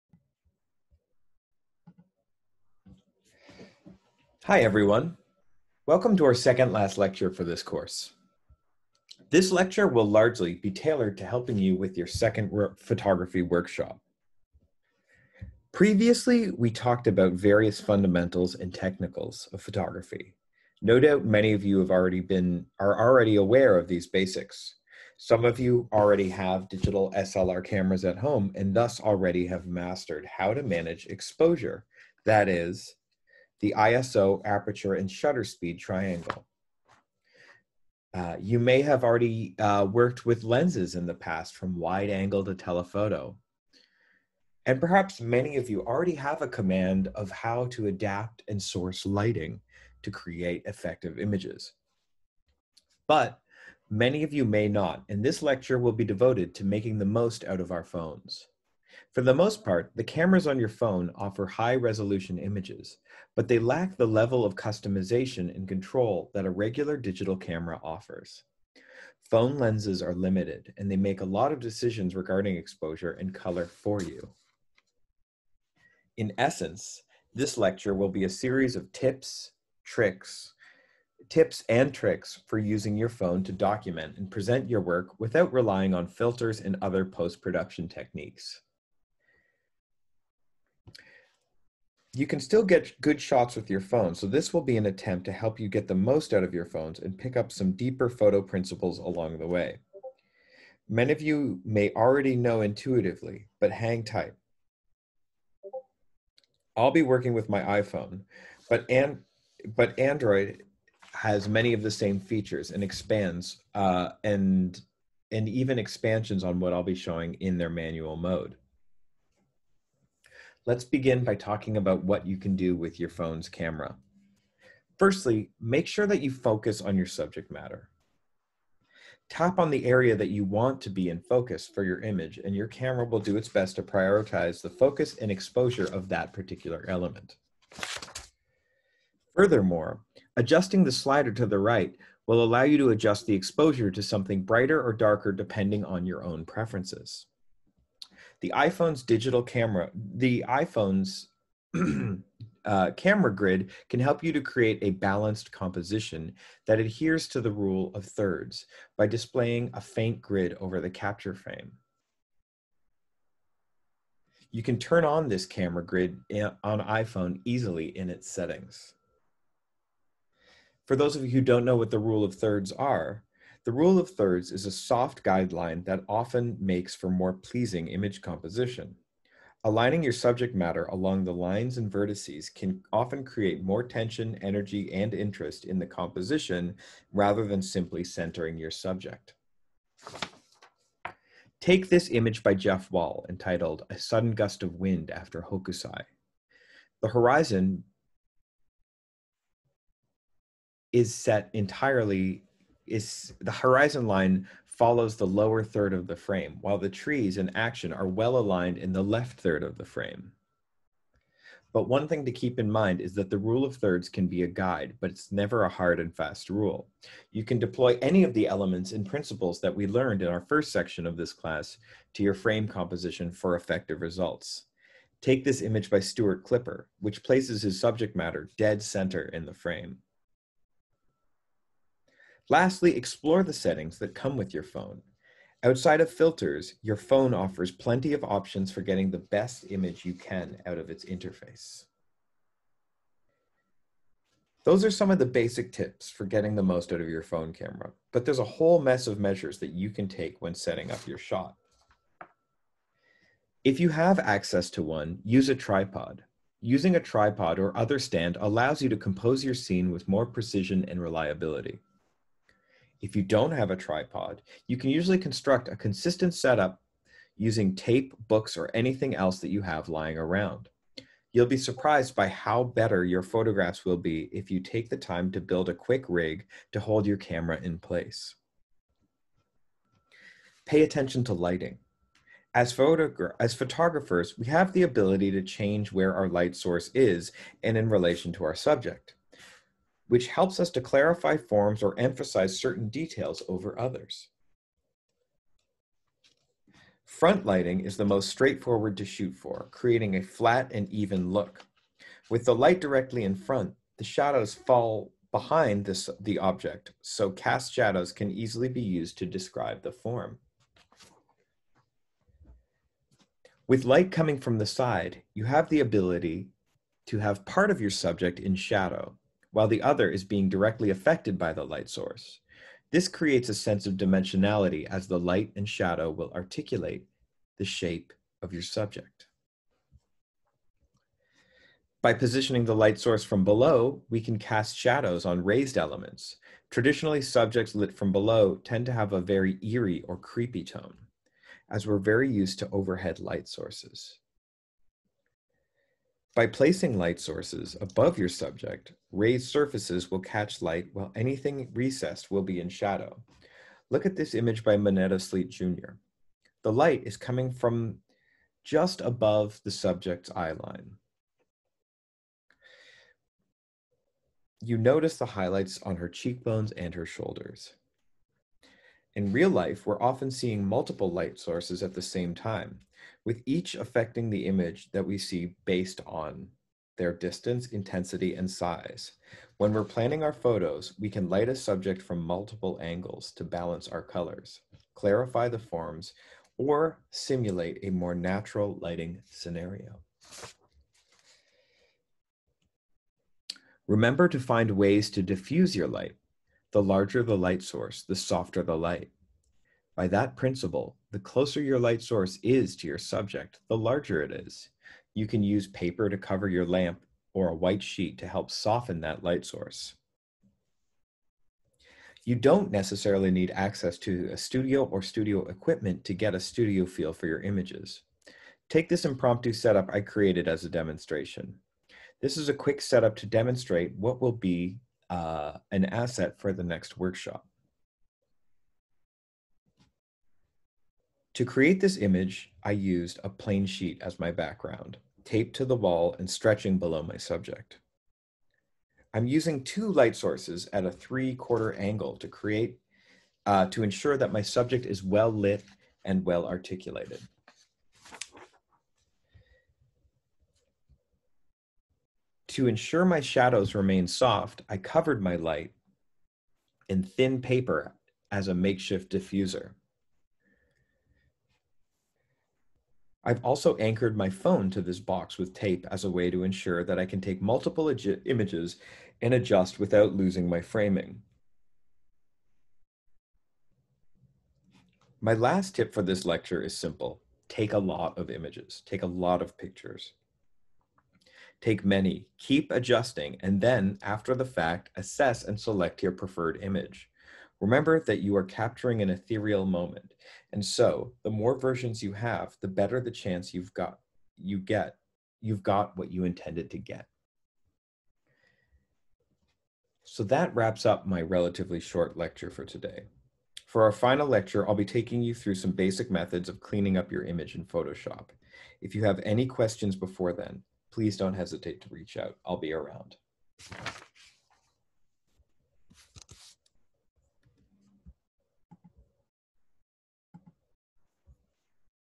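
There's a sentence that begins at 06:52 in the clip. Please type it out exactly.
You don't necessarily need access to a studio or studio equipment to get a studio feel for your images.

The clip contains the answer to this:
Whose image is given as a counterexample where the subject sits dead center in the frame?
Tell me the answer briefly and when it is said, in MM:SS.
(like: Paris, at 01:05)
Stuart Klipper, at 03:46.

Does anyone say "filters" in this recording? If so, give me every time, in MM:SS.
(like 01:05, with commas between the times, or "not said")
01:26, 03:56.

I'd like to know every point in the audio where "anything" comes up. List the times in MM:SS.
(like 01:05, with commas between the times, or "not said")
04:28, 05:51.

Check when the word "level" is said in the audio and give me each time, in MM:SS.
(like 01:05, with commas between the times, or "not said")
01:04.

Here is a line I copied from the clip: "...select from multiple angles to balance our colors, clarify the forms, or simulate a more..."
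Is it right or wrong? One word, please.
wrong.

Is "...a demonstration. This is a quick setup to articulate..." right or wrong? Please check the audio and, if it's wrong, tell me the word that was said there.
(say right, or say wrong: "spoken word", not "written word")
wrong: "demonstrate", not "articulate".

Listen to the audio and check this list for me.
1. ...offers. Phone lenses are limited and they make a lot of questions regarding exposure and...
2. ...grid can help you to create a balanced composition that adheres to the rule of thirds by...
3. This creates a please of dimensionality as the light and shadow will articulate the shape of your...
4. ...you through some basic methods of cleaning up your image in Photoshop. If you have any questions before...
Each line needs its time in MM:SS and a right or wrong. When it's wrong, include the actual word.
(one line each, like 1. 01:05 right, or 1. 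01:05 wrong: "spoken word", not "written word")
1. 01:07 wrong: "decisions", not "questions"
2. 02:33 right
3. 05:22 wrong: "sense", not "please"
4. 08:25 right.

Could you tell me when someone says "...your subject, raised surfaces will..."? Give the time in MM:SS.
05:48.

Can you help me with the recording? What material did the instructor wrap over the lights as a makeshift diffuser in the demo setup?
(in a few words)
thin paper.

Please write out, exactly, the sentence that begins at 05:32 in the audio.
By positioning the light source from below, we can cast shadows on raised elements.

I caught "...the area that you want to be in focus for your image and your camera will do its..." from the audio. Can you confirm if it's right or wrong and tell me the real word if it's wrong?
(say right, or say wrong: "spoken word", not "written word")
right.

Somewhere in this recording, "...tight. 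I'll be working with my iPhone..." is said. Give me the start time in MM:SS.
01:44.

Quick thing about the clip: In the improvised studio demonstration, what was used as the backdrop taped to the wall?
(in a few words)
a plain sheet.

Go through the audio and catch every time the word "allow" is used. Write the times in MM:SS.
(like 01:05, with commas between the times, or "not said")
02:22, 04:18.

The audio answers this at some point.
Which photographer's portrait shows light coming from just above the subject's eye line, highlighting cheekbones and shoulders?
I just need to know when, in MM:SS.
05:54.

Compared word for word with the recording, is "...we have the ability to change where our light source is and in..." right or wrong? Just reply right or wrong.
right.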